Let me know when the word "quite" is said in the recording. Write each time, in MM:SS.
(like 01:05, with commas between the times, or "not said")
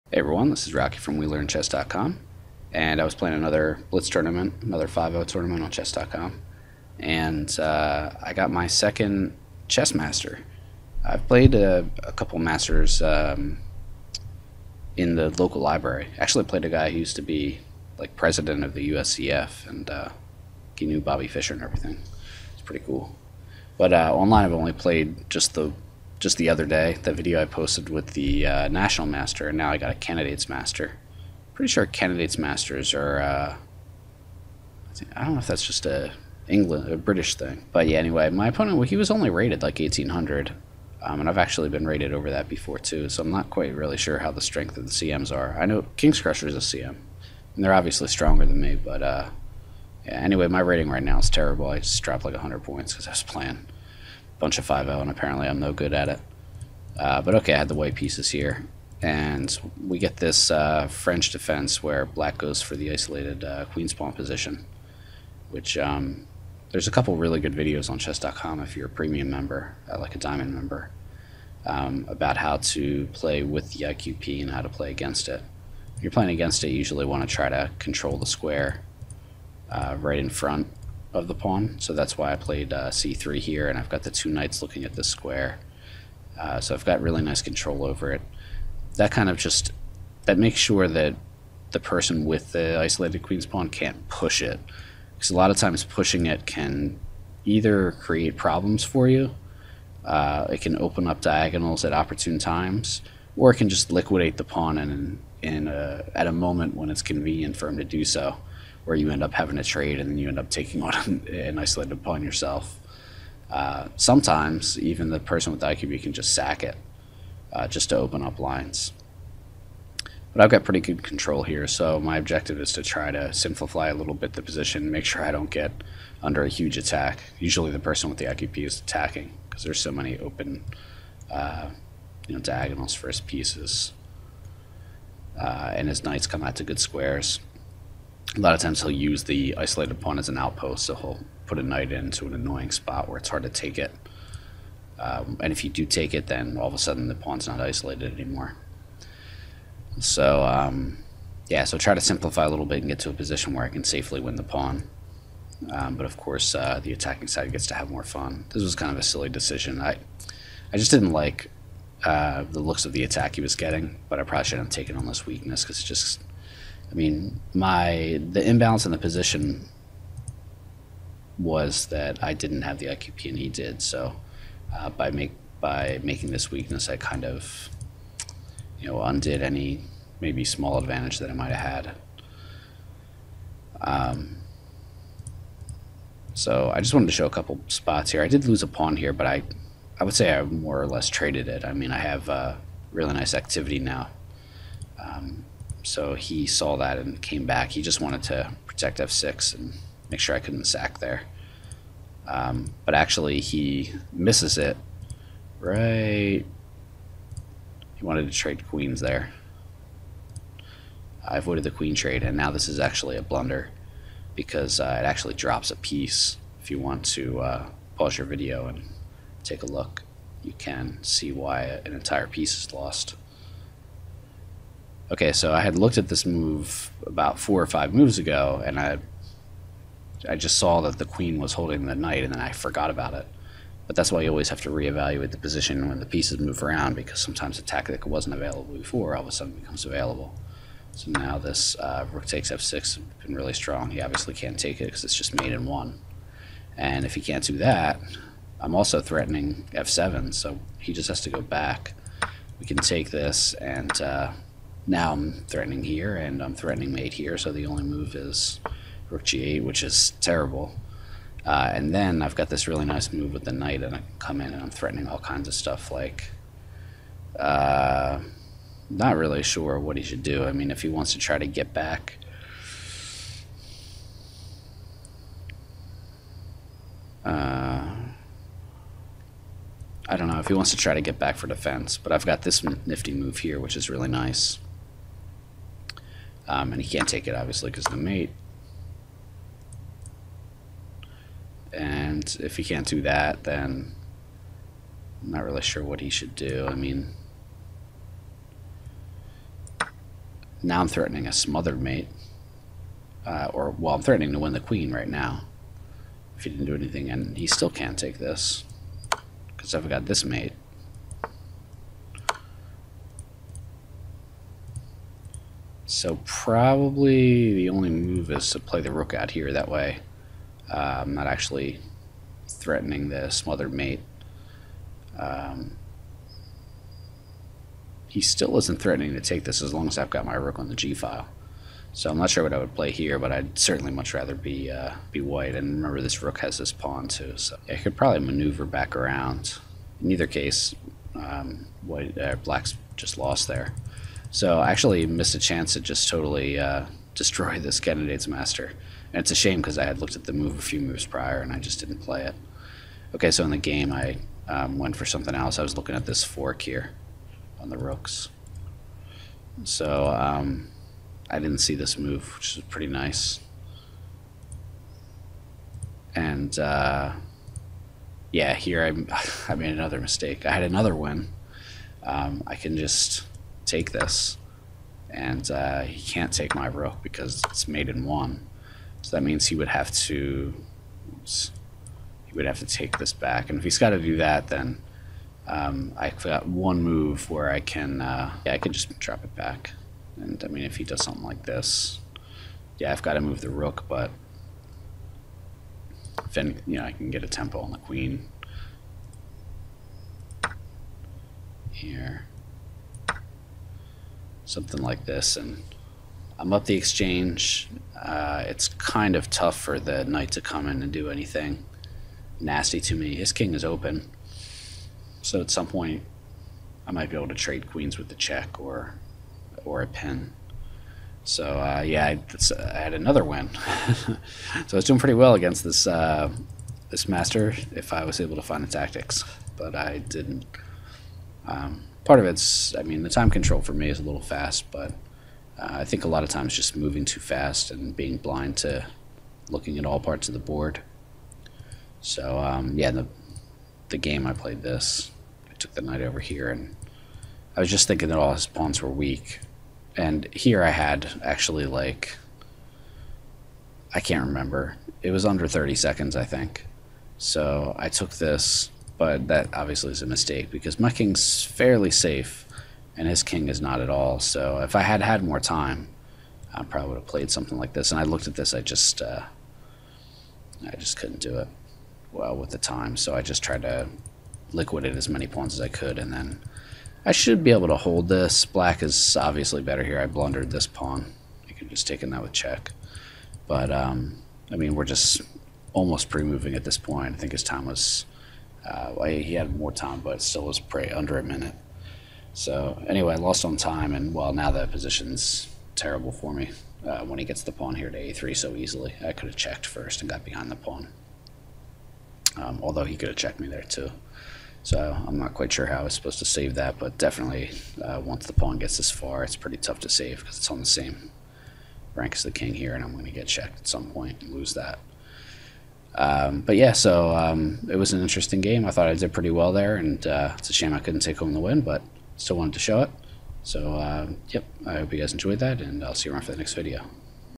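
00:43, 08:25.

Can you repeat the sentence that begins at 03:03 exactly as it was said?
Um, so I just wanted to show a couple spots here.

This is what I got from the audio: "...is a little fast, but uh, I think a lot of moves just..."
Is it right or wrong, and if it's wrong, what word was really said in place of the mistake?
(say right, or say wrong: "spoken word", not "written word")
wrong: "times", not "moves".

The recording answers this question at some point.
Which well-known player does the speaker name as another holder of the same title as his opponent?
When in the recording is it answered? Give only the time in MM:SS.
00:45.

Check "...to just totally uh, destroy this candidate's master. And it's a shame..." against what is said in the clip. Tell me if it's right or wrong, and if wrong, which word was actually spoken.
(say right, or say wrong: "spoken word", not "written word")
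right.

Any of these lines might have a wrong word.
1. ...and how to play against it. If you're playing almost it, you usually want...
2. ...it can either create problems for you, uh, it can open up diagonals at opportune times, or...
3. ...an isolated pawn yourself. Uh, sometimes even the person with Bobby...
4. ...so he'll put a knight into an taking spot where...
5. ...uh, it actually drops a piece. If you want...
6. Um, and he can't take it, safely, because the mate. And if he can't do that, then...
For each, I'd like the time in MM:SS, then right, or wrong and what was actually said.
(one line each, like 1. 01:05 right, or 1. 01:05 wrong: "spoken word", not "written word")
1. 01:14 wrong: "against", not "almost"
2. 01:36 right
3. 01:51 wrong: "IQP", not "Bobby"
4. 02:20 wrong: "annoying", not "taking"
5. 03:34 right
6. 04:46 wrong: "obviously", not "safely".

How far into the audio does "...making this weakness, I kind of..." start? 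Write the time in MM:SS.
02:56.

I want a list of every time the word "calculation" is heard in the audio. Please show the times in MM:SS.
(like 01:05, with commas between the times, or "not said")
not said.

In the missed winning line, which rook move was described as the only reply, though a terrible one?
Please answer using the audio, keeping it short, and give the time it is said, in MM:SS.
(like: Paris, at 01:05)
rook g8, at 04:19.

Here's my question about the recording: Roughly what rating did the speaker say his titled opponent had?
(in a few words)
1800.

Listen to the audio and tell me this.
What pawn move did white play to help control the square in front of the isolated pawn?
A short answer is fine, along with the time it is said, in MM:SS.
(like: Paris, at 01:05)
c3, at 01:22.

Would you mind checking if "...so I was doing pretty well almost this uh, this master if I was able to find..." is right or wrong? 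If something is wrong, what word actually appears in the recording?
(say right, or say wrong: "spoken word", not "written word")
wrong: "against", not "almost".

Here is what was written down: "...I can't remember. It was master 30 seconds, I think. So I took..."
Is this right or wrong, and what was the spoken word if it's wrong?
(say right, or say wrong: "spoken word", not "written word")
wrong: "under", not "master".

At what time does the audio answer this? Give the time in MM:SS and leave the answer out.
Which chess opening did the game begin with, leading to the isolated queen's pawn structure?
01:00.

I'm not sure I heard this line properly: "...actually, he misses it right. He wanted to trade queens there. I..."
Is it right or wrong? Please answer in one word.
right.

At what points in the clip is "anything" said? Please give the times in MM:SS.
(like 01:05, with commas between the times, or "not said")
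05:06, 06:51.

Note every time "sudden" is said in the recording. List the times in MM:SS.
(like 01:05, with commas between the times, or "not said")
02:26, 03:59.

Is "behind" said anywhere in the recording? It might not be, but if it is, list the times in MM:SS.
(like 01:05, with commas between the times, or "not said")
08:20.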